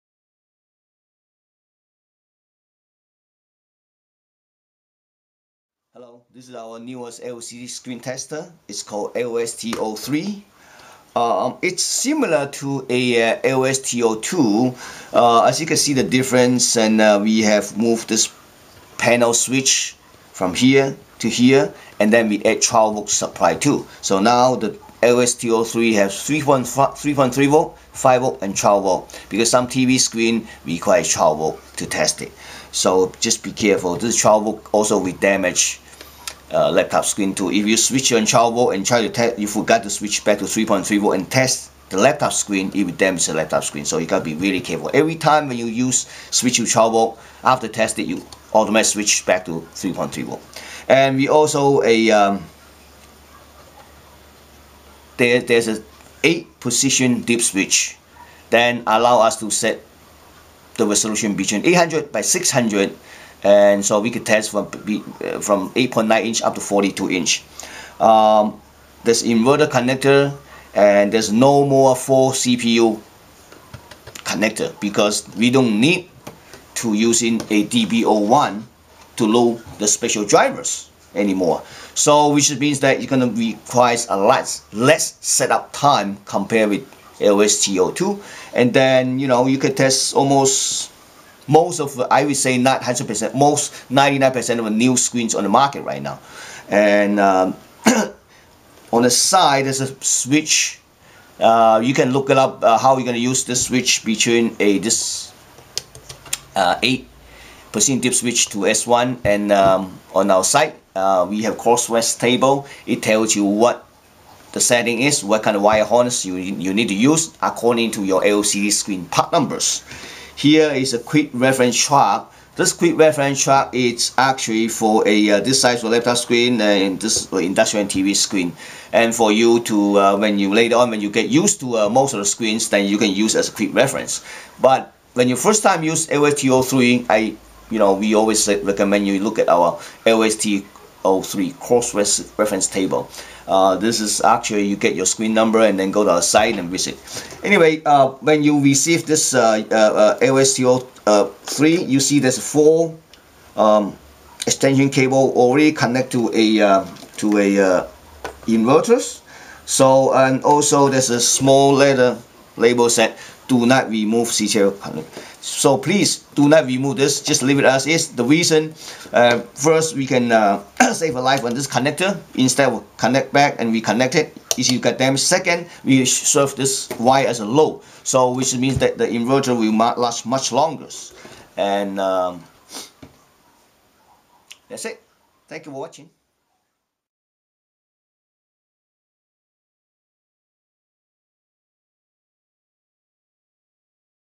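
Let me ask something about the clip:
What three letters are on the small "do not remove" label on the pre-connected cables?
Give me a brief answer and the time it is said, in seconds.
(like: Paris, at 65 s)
CTL, at 164 s.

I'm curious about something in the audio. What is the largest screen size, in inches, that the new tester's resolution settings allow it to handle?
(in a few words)
42 inch.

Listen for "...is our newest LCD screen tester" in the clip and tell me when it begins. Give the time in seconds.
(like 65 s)
6 s.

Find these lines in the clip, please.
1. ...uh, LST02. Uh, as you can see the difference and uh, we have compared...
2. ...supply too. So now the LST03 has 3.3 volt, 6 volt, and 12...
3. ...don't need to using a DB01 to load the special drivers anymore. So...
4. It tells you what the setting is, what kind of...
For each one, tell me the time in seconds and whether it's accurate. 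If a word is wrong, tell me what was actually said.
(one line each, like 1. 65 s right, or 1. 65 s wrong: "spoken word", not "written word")
1. 13 s wrong: "moved", not "compared"
2. 23 s wrong: "5", not "6"
3. 75 s right
4. 112 s right.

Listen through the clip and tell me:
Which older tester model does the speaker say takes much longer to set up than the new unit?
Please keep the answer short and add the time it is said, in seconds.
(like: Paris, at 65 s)
LST02, at 87 s.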